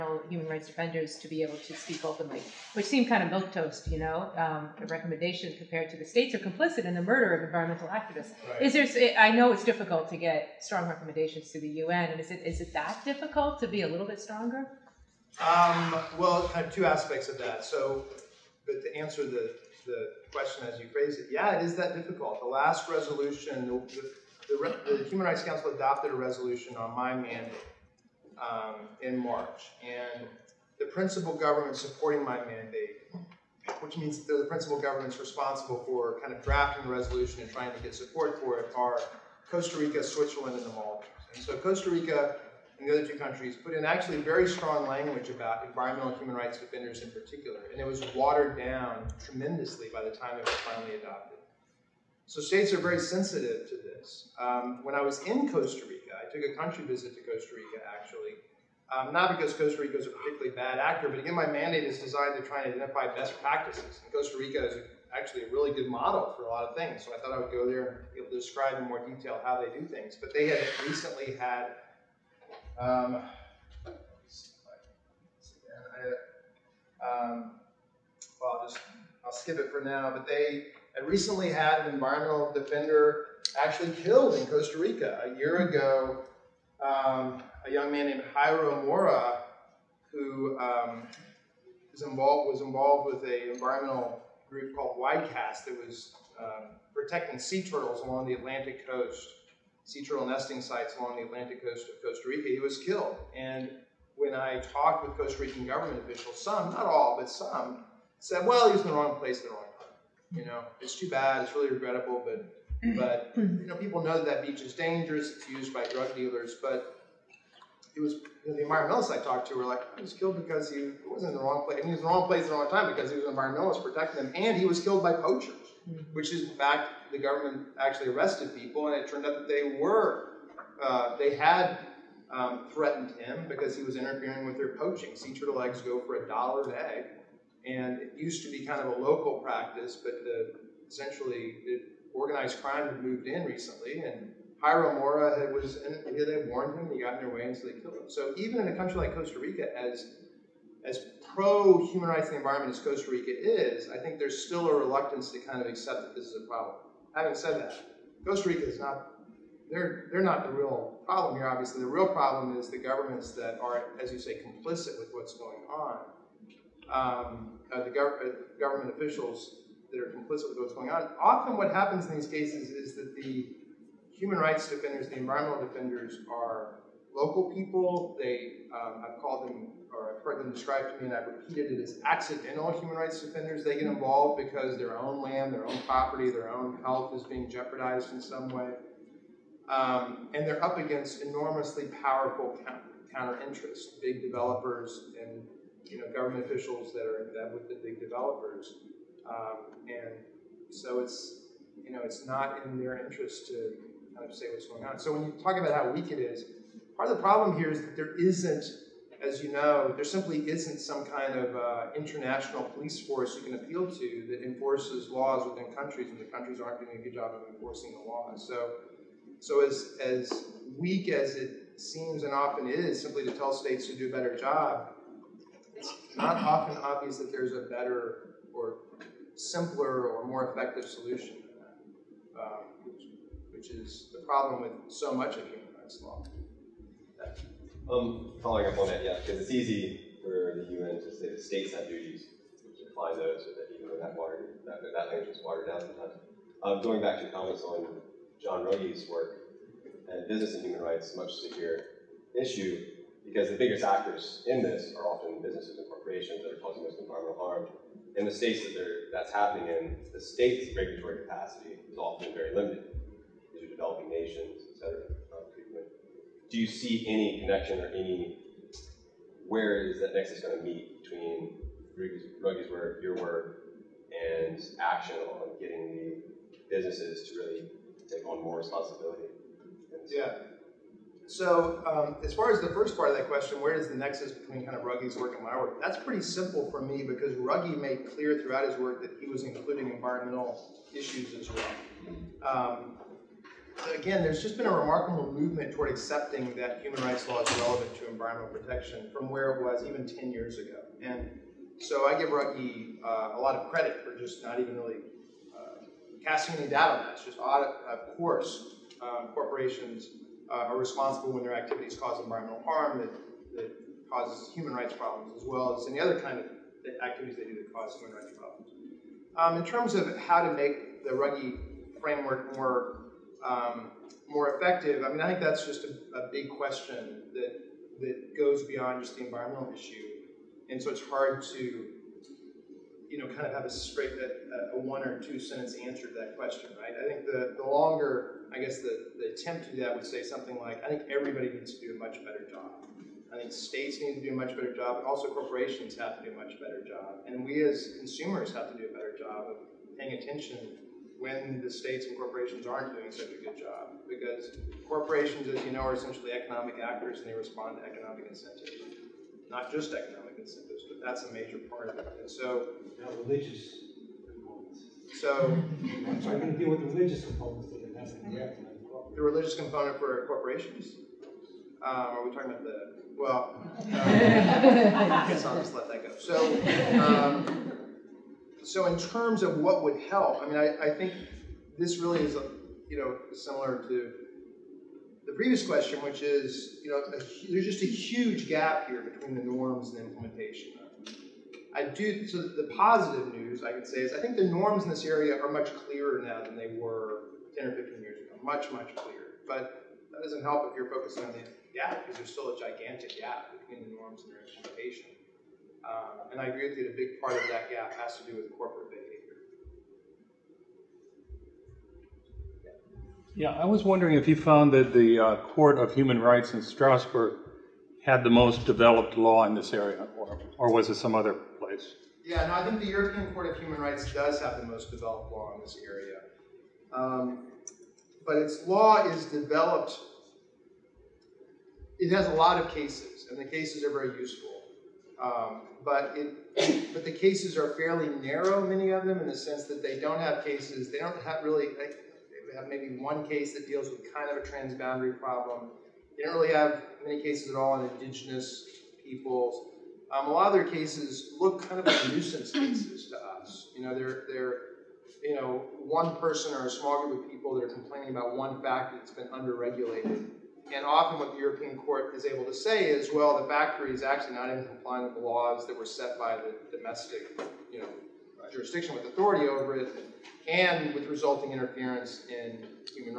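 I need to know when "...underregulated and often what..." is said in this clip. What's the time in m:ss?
7:39.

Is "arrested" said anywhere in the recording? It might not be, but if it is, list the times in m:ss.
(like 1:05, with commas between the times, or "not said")
2:08.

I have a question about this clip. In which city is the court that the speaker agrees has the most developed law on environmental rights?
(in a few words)
Strasbourg.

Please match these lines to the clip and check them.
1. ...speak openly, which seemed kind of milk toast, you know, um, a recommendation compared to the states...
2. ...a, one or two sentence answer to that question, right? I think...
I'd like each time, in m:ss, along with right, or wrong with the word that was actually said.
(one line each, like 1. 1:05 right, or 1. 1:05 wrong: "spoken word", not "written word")
1. 0:01 right
2. 5:34 right.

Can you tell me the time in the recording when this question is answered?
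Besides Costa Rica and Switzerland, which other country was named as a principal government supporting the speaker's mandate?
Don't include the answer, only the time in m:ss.
0:40.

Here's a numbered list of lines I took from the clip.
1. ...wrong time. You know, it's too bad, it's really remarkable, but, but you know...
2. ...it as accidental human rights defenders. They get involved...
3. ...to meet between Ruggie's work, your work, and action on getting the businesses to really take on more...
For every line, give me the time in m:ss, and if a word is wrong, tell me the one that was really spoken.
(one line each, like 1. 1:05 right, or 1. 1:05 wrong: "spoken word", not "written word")
1. 1:49 wrong: "regrettable", not "remarkable"
2. 3:01 right
3. 4:30 right.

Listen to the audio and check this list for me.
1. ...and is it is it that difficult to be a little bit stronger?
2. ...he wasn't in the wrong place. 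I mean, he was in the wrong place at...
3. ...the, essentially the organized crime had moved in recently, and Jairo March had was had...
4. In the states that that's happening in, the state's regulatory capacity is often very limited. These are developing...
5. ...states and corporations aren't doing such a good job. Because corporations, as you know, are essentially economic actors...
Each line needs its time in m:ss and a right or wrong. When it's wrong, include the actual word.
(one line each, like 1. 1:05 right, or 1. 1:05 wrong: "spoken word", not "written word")
1. 0:12 right
2. 2:00 right
3. 2:20 wrong: "Mora", not "March"
4. 4:18 right
5. 5:51 right.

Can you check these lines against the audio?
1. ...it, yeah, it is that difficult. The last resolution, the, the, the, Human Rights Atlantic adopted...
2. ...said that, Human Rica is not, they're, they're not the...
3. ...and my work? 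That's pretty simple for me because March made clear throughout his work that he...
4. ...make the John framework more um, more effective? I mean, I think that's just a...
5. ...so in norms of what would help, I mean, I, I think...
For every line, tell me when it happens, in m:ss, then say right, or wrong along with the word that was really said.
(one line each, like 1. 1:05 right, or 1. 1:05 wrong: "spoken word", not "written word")
1. 0:21 wrong: "Council", not "Atlantic"
2. 2:37 wrong: "Costa", not "Human"
3. 4:45 wrong: "Ruggie", not "March"
4. 5:20 wrong: "Ruggie", not "John"
5. 6:18 wrong: "terms", not "norms".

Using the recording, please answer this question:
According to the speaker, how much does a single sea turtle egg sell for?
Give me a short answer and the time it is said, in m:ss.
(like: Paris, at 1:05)
a dollar, at 2:16.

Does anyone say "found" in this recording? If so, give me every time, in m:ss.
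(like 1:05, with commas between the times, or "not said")
6:54.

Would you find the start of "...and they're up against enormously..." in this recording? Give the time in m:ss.
3:10.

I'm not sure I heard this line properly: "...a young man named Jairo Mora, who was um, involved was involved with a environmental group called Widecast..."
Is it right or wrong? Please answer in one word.
right.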